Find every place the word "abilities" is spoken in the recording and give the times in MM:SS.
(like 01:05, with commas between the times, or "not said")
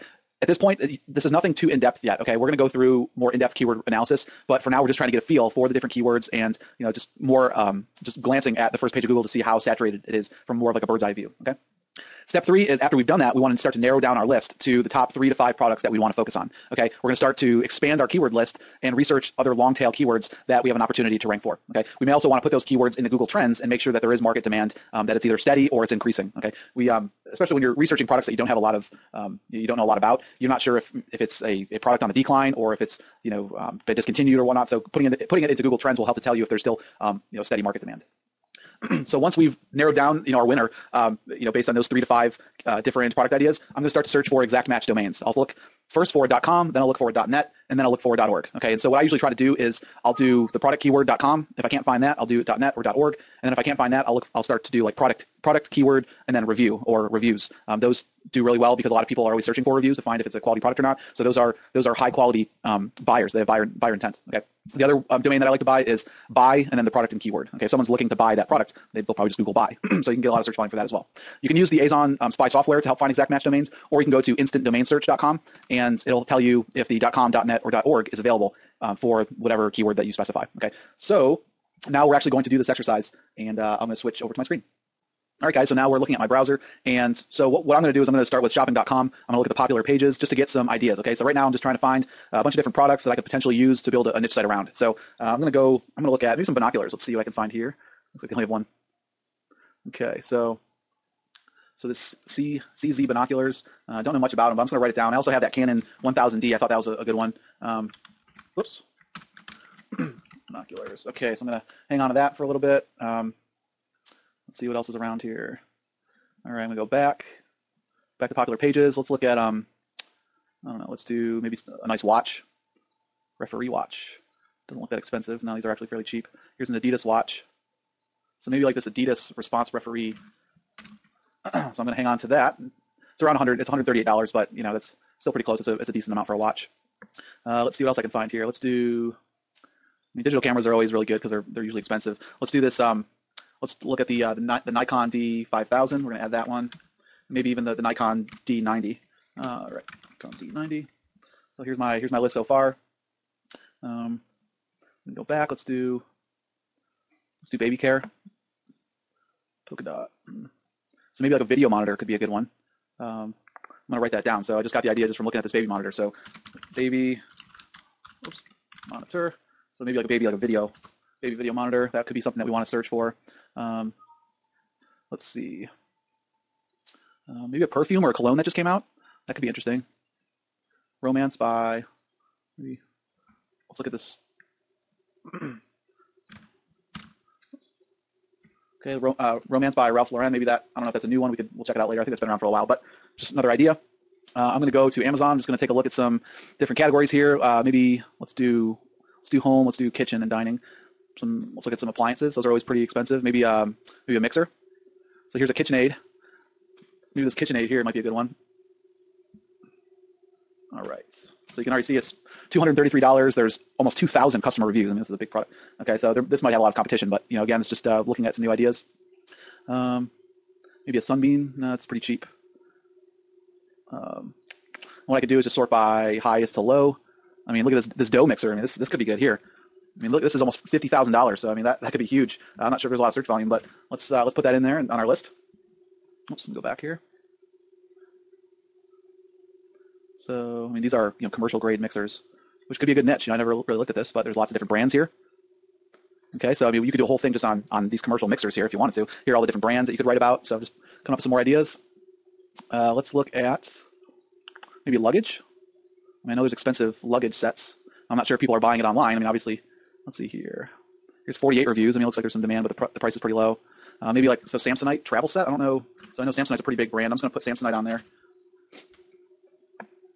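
not said.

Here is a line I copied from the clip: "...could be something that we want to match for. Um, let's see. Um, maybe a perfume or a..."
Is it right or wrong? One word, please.
wrong.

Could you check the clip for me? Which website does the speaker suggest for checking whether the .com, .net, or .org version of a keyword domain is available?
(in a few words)
instantdomainsearch.com.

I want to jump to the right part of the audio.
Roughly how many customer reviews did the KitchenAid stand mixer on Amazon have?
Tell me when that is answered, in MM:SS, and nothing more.
03:33.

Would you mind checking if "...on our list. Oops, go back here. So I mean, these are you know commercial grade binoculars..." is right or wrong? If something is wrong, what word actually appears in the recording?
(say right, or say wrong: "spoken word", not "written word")
wrong: "mixers", not "binoculars".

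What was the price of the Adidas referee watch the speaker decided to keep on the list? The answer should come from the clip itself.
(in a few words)
$138.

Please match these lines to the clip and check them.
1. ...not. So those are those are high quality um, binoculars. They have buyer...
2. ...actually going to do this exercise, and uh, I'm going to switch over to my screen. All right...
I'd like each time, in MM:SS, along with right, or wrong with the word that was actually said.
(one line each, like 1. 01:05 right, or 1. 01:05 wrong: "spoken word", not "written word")
1. 01:00 wrong: "buyers", not "binoculars"
2. 01:22 right.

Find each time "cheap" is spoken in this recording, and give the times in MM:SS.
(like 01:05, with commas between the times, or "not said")
02:06, 03:41.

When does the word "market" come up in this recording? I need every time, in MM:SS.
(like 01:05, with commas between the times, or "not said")
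00:24, 00:37.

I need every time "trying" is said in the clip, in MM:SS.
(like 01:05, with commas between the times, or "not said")
00:04, 01:31.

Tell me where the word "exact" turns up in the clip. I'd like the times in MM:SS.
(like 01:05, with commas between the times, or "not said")
00:44, 01:13.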